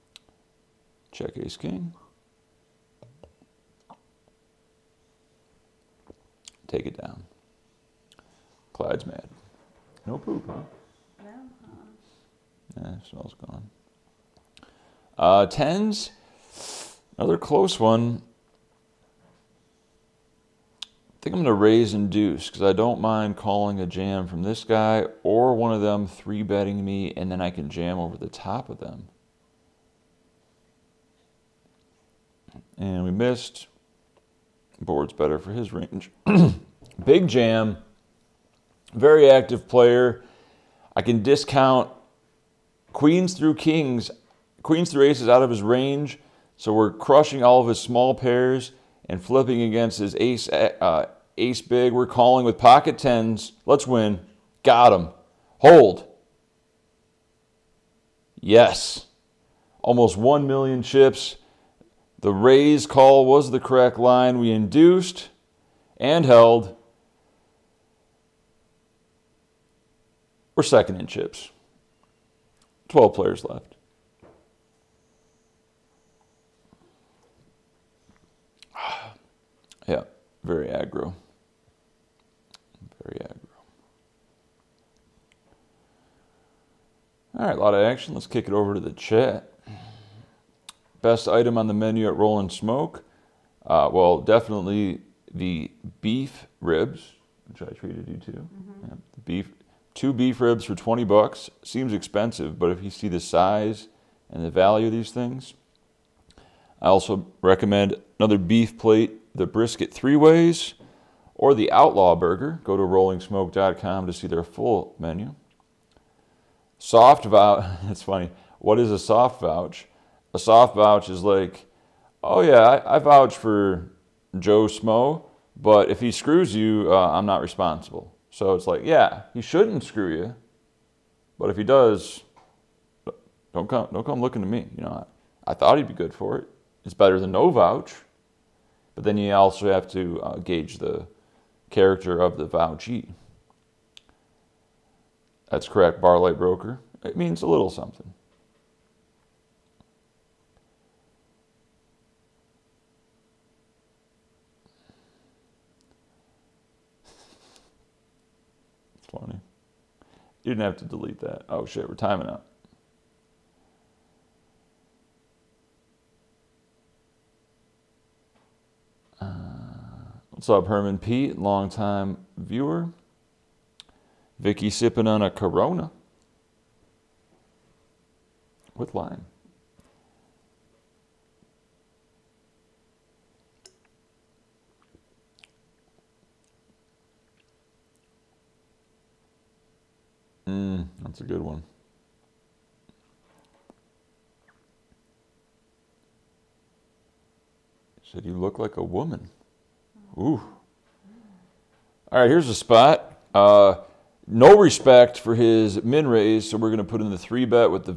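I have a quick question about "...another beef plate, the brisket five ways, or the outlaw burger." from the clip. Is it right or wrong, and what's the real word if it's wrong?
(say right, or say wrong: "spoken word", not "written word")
wrong: "three", not "five".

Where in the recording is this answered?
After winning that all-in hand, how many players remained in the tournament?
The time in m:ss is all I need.
1:12.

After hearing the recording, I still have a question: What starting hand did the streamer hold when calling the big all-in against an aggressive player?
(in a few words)
pocket tens.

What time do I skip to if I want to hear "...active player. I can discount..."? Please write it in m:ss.
0:39.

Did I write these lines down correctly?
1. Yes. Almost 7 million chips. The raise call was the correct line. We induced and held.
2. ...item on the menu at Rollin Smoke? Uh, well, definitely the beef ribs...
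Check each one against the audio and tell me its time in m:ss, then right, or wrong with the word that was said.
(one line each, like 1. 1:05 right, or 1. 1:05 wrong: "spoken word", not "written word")
1. 0:58 wrong: "1", not "7"
2. 1:31 right.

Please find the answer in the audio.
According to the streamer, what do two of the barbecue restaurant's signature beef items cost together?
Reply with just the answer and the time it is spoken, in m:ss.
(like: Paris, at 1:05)
$20, at 1:40.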